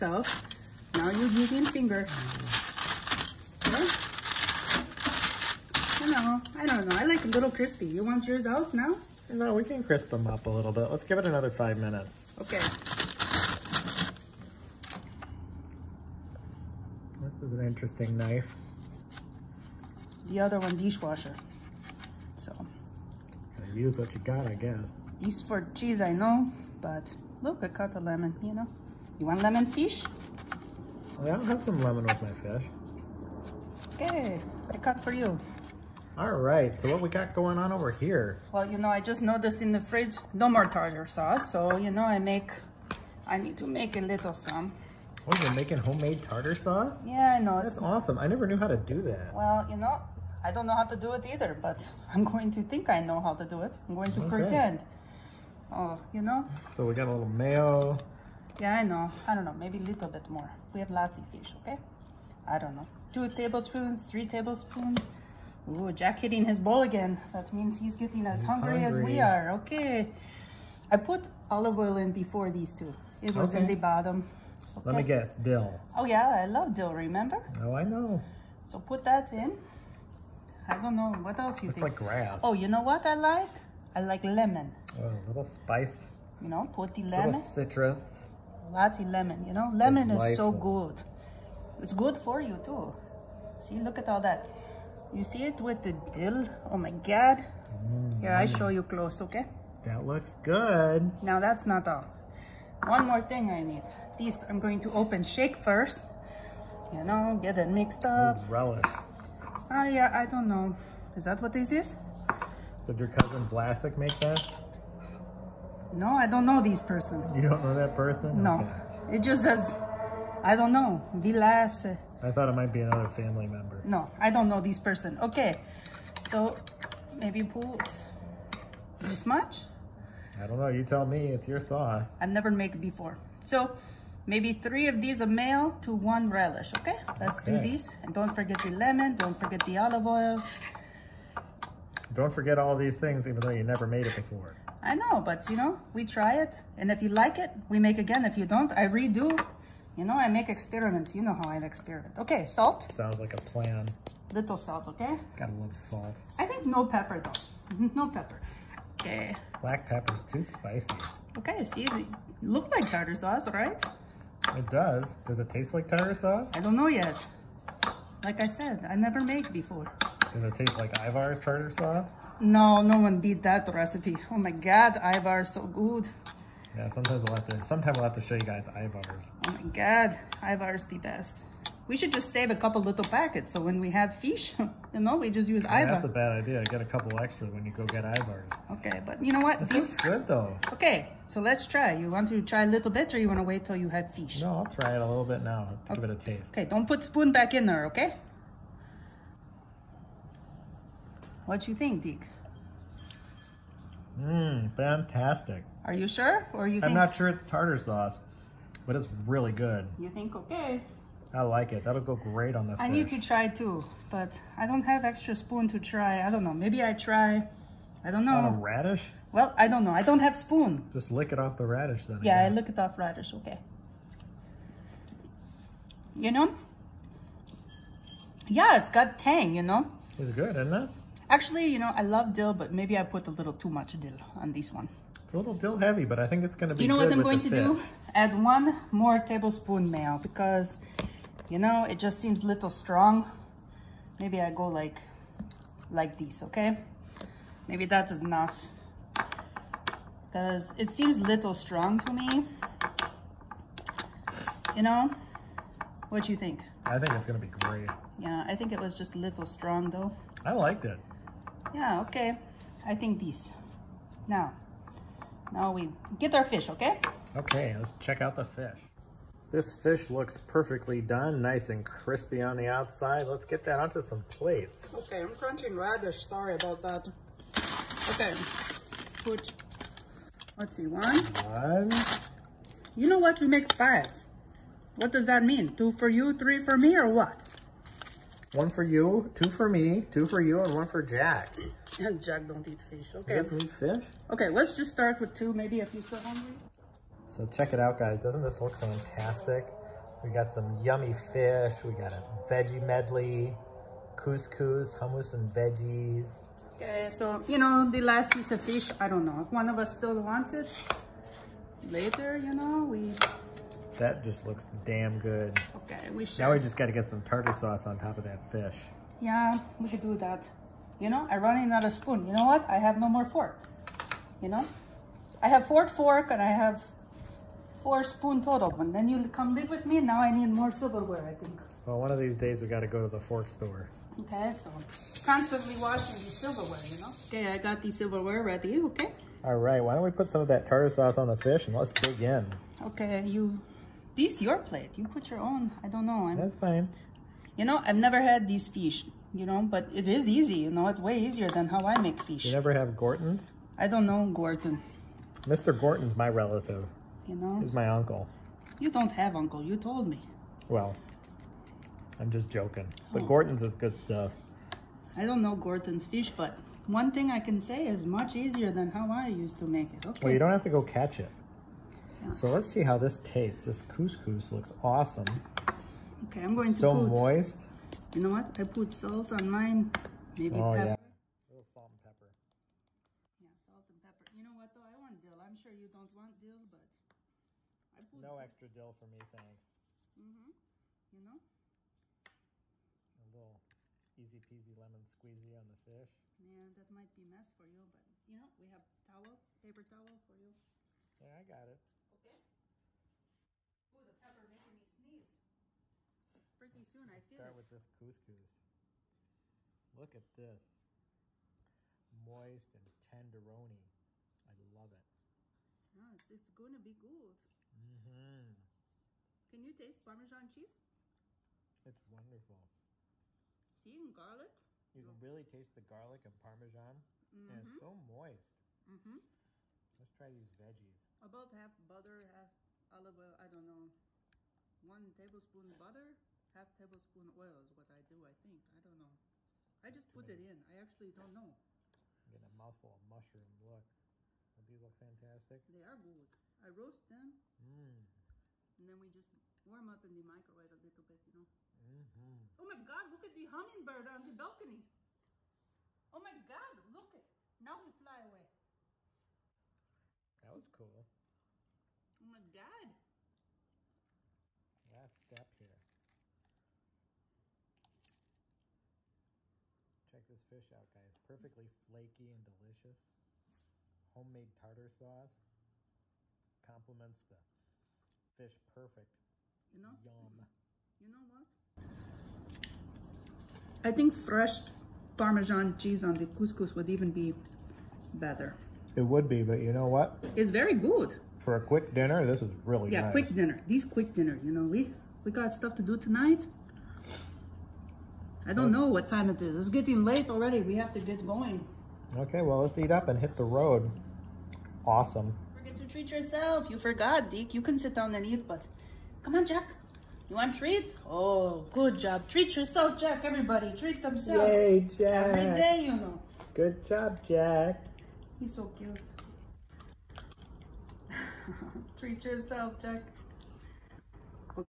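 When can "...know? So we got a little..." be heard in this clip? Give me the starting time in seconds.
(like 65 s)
56 s.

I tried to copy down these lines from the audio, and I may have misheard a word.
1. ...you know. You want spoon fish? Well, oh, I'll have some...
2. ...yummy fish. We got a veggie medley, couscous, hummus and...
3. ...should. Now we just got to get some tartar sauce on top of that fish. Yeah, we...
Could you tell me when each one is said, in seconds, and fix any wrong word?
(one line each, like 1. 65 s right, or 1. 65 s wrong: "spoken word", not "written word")
1. 28 s wrong: "lemon", not "spoon"
2. 300 s right
3. 316 s right.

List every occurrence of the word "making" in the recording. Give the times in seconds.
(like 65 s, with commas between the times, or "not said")
45 s, 404 s.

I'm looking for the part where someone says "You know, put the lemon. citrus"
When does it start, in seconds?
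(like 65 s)
86 s.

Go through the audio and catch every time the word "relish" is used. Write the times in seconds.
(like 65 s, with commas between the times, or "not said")
108 s, 136 s.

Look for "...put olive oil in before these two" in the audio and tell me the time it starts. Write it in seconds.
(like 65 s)
70 s.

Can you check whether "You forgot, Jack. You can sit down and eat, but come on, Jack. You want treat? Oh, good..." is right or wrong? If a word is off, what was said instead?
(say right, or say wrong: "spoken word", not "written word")
wrong: "Dick", not "Jack".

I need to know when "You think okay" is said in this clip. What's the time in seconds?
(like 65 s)
209 s.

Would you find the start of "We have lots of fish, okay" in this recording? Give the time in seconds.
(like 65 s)
60 s.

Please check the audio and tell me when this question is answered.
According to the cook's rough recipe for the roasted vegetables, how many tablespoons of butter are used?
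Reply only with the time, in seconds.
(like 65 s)
434 s.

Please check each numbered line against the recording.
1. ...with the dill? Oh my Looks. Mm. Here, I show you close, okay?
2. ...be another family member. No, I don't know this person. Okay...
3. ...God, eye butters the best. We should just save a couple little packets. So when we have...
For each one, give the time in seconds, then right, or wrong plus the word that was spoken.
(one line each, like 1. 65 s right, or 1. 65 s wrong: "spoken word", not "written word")
1. 95 s wrong: "God", not "Looks"
2. 122 s right
3. 179 s right.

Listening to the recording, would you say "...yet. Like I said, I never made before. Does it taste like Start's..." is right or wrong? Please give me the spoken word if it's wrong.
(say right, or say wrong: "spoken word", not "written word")
wrong: "Ivar", not "Start".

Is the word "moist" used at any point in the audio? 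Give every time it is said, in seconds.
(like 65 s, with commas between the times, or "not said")
377 s, 412 s, 427 s.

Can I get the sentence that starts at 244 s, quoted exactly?
Maybe I go like, like this, okay?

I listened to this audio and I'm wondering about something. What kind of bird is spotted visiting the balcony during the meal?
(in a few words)
hummingbird.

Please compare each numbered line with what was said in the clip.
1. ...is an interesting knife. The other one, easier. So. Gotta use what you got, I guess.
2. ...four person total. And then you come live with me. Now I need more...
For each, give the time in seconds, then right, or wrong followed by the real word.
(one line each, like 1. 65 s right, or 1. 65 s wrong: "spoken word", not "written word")
1. 17 s wrong: "dishwasher", not "easier"
2. 327 s wrong: "spoon", not "person".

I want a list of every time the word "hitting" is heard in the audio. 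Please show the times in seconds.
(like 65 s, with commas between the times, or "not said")
66 s.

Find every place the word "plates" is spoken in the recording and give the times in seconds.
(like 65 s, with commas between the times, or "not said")
274 s, 344 s.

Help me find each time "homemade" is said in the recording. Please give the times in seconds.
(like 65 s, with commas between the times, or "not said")
45 s, 474 s.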